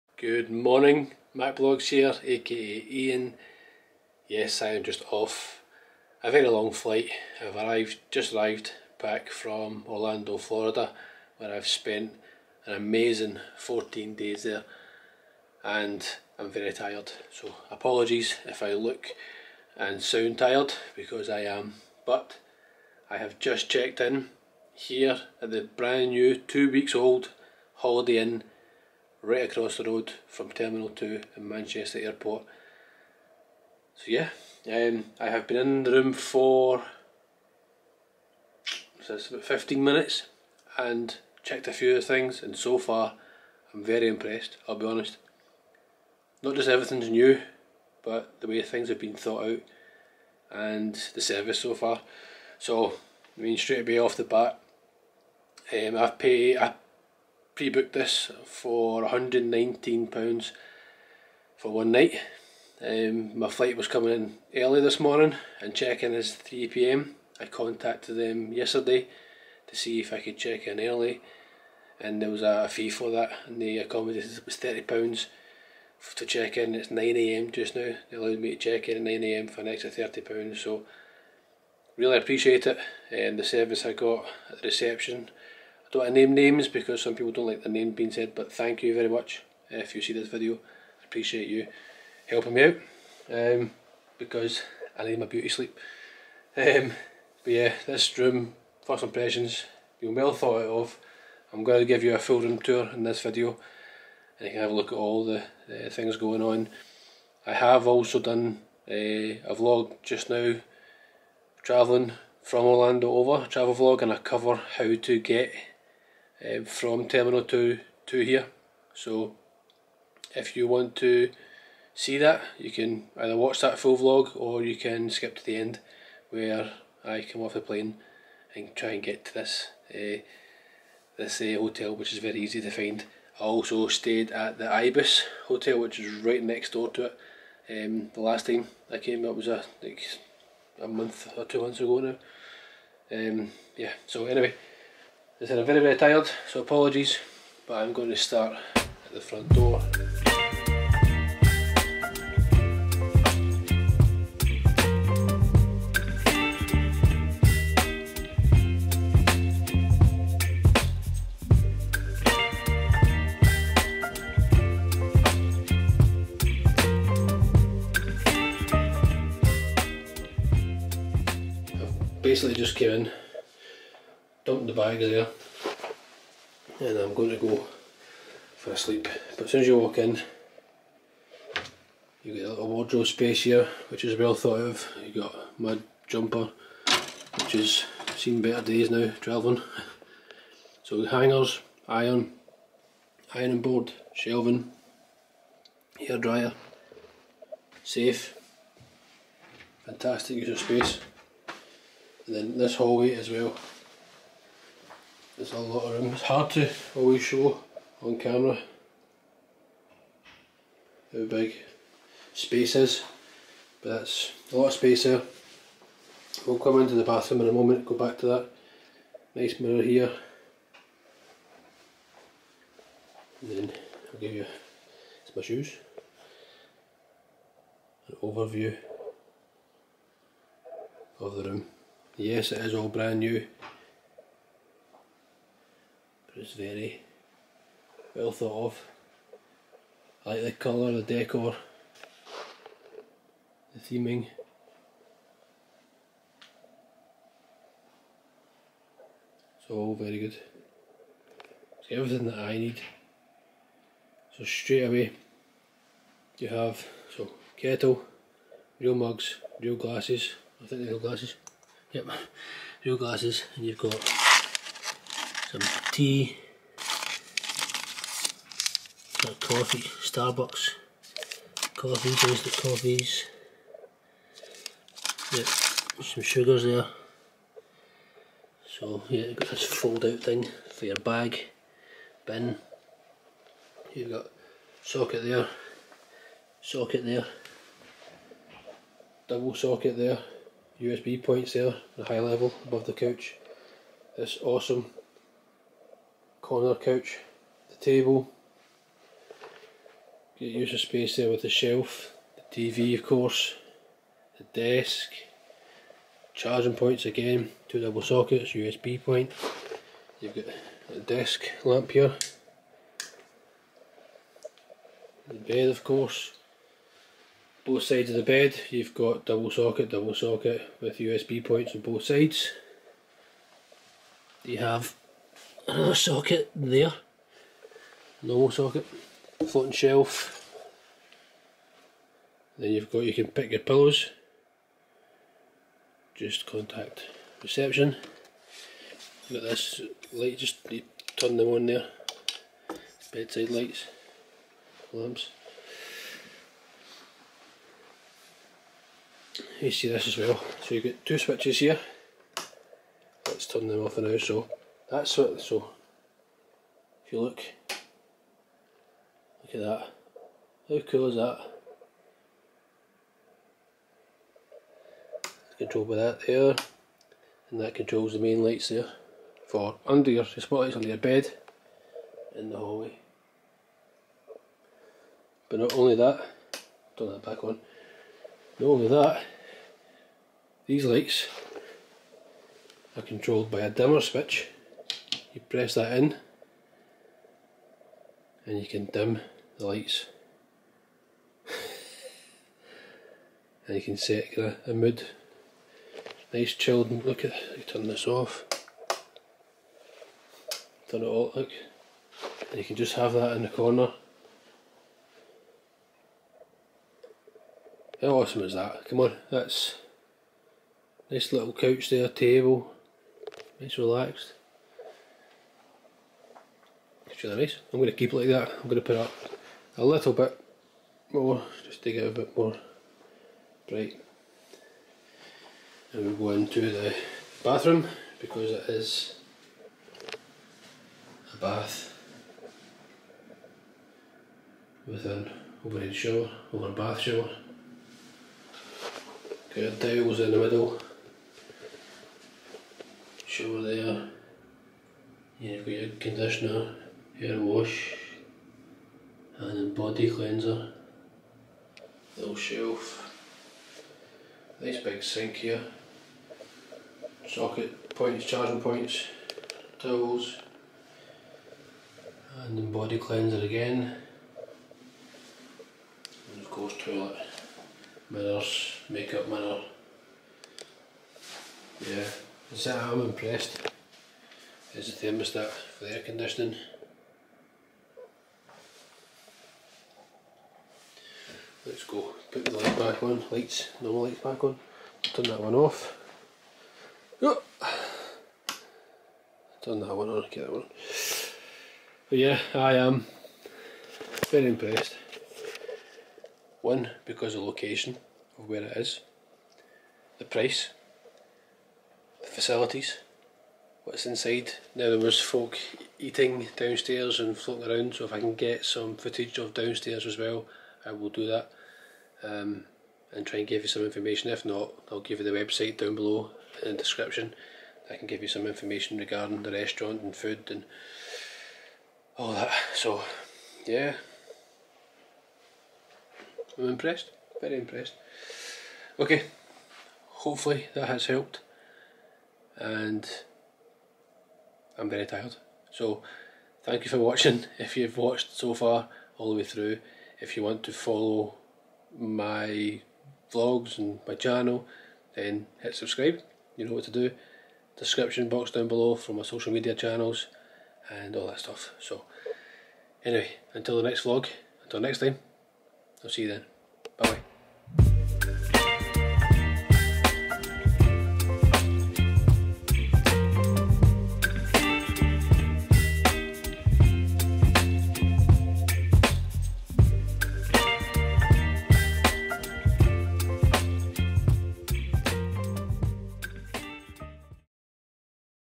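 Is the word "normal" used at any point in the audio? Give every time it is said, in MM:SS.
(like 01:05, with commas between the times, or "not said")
05:28, 08:03.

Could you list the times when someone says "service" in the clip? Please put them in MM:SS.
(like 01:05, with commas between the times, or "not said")
00:51, 01:23.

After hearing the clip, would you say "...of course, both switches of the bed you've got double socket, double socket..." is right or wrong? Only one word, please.
wrong.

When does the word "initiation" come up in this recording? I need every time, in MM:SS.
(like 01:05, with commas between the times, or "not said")
not said.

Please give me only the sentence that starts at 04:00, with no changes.
I like the colour, the decor, the theming.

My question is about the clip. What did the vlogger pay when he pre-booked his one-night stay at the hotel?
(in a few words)
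£119.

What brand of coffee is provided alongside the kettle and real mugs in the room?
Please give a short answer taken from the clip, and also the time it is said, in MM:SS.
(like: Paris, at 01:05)
Starbucks, at 04:29.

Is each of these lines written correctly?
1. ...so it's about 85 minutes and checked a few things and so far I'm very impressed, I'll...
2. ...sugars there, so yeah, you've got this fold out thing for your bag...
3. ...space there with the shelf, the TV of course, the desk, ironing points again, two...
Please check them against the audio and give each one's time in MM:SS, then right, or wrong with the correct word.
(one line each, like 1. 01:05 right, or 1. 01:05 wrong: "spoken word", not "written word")
1. 00:39 wrong: "15", not "85"
2. 04:36 right
3. 05:00 wrong: "charging", not "ironing".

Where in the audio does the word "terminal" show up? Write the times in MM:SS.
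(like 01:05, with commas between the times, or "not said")
00:30, 01:57.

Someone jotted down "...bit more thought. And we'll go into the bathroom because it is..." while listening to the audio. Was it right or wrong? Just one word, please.
wrong.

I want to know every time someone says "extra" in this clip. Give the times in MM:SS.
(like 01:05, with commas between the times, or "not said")
01:19.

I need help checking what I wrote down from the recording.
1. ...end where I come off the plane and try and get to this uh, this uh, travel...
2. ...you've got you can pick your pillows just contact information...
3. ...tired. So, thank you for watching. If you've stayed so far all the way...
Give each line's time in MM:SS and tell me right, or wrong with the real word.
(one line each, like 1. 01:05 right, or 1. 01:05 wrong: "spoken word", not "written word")
1. 02:05 wrong: "hotel", not "travel"
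2. 05:32 wrong: "reception", not "information"
3. 08:55 wrong: "watched", not "stayed".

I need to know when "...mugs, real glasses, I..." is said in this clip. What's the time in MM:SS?
04:18.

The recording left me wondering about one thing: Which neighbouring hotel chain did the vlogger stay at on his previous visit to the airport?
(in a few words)
Ibis.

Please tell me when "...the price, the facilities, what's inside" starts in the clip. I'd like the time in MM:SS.
08:20.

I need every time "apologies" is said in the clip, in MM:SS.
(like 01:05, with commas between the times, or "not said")
00:17, 02:26.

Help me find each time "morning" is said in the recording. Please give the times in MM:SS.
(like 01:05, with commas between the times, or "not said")
00:00, 01:04.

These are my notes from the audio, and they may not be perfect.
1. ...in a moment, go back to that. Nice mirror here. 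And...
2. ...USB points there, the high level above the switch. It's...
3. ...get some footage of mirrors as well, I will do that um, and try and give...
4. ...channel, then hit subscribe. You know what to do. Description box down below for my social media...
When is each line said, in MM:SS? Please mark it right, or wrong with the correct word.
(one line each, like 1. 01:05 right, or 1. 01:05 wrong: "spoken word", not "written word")
1. 03:37 right
2. 04:50 wrong: "couch", not "switch"
3. 08:28 wrong: "downstairs", not "mirrors"
4. 09:04 right.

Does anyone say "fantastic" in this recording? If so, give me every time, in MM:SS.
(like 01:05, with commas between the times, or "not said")
03:19.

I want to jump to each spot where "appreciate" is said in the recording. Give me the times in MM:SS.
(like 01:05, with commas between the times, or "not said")
01:22, 01:31.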